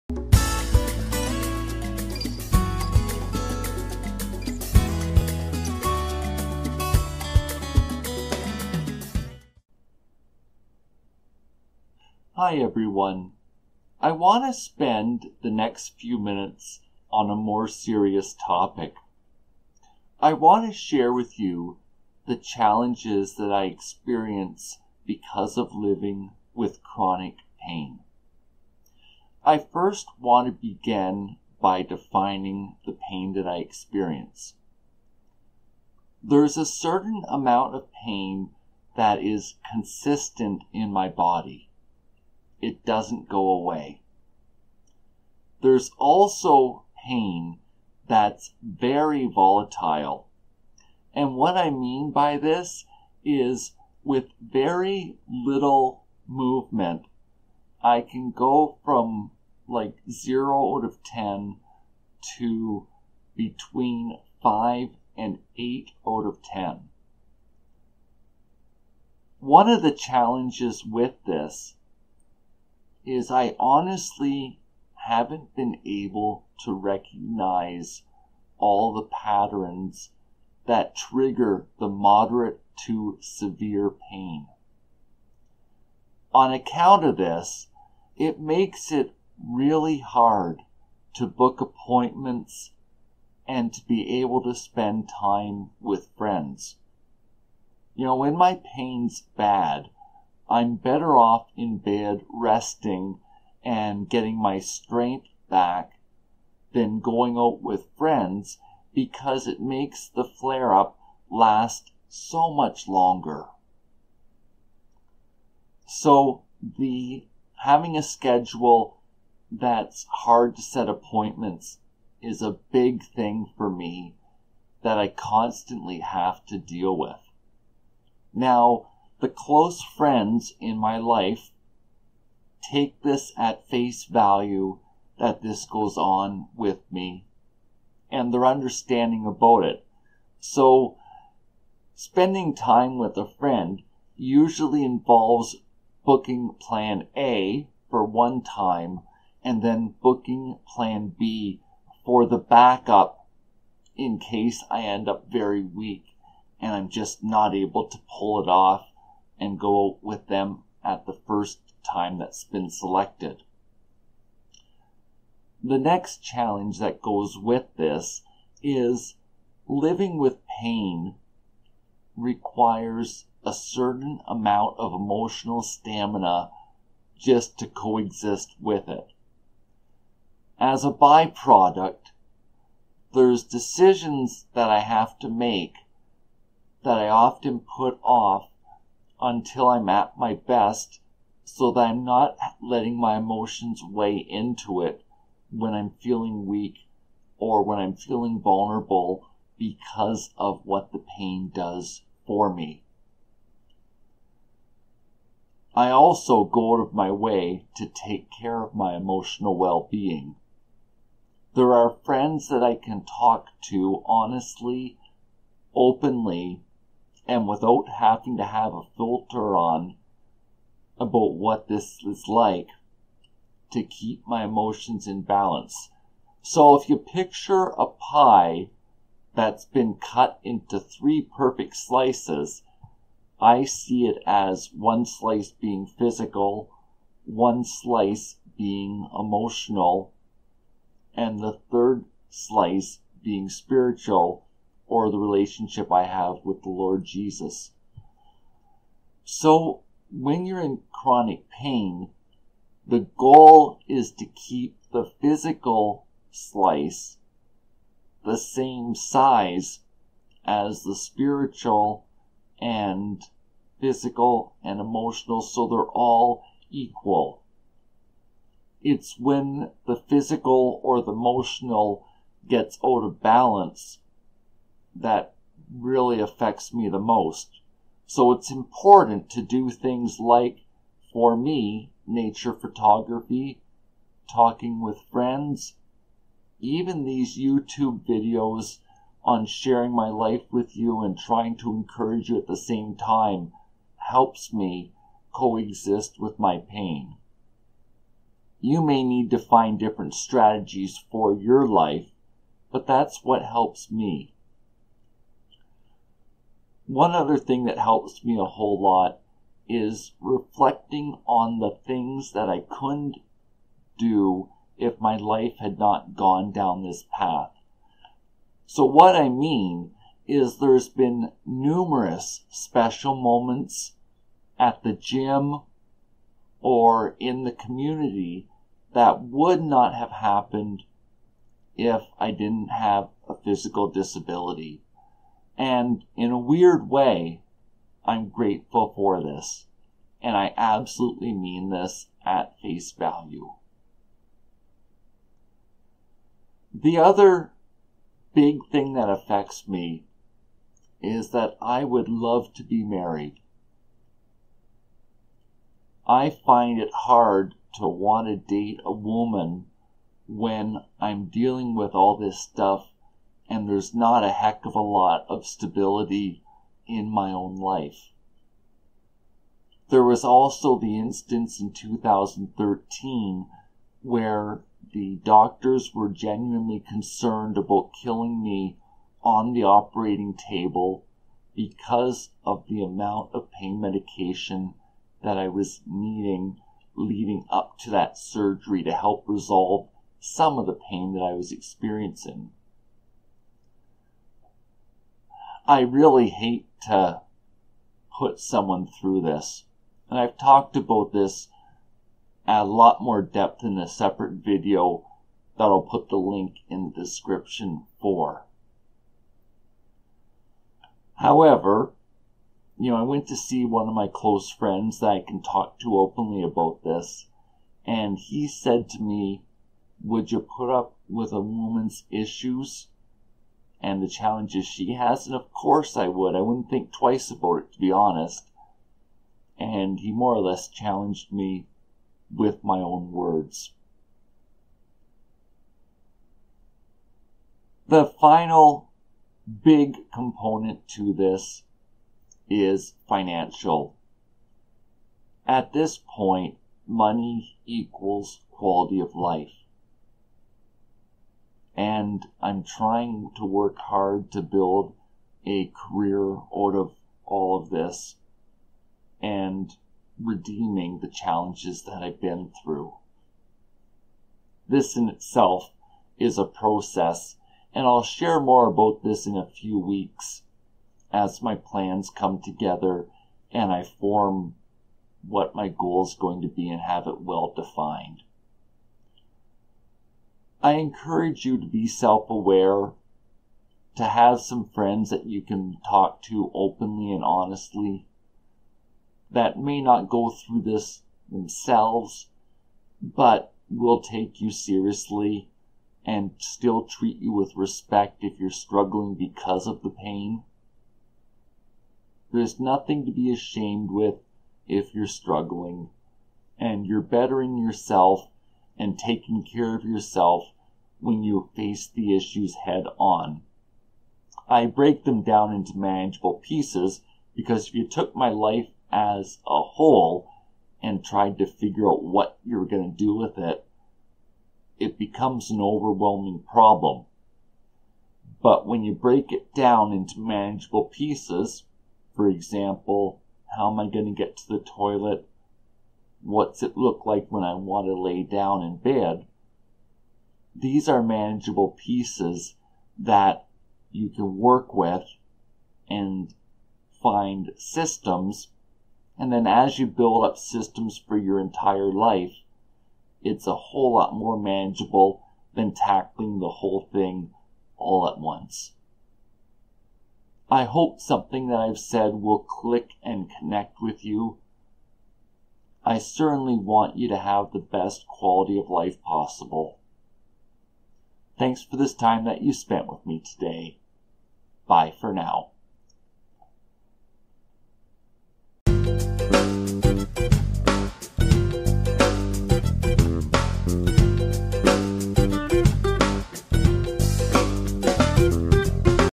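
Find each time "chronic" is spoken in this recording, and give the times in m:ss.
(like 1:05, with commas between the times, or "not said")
0:26, 4:10.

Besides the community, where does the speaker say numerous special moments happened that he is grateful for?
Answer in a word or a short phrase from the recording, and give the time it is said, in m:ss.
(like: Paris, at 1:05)
The gym, at 5:24.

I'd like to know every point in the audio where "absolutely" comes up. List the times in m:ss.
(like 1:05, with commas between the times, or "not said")
5:40.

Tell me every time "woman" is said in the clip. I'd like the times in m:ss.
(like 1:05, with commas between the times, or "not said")
5:58, 7:01.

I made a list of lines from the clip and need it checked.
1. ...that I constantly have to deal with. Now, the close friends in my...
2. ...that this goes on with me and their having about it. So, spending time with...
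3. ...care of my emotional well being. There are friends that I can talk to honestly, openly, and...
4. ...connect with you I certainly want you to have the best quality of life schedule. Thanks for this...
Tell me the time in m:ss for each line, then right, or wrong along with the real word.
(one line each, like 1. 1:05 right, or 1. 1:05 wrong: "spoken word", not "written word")
1. 2:04 right
2. 2:15 wrong: "understanding", not "having"
3. 3:28 right
4. 9:23 wrong: "possible", not "schedule".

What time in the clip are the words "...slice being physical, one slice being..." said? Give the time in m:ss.
3:55.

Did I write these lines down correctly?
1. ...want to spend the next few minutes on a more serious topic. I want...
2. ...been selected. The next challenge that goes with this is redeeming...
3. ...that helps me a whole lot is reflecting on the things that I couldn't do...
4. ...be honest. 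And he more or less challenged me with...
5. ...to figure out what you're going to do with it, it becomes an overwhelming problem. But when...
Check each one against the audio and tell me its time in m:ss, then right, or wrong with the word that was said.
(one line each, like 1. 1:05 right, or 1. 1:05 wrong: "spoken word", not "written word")
1. 0:14 right
2. 2:42 wrong: "living", not "redeeming"
3. 5:07 right
4. 7:07 right
5. 8:41 right.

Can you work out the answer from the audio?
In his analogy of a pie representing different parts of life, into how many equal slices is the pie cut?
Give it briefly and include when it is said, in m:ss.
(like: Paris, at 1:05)
3, at 3:50.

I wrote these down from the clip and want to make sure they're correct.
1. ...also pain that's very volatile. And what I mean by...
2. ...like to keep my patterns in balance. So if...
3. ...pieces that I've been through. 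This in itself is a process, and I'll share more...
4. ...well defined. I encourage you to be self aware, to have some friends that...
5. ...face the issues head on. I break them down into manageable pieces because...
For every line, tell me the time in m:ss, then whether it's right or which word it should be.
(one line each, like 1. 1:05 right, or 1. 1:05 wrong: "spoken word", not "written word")
1. 0:45 right
2. 3:42 wrong: "emotions", not "patterns"
3. 7:41 wrong: "challenges", not "pieces"
4. 7:57 right
5. 8:31 right.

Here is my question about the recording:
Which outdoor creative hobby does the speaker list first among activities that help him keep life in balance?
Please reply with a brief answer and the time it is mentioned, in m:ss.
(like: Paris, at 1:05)
Nature photography, at 4:42.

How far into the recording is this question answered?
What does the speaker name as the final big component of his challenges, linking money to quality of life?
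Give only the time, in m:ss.
7:23.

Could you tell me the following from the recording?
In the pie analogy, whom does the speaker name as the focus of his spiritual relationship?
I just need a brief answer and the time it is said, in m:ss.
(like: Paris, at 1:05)
the Lord Jesus, at 4:06.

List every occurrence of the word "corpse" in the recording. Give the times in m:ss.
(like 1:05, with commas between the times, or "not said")
not said.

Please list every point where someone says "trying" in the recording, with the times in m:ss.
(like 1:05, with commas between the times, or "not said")
4:51, 7:32.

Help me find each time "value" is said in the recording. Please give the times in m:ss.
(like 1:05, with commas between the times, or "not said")
2:14, 5:42.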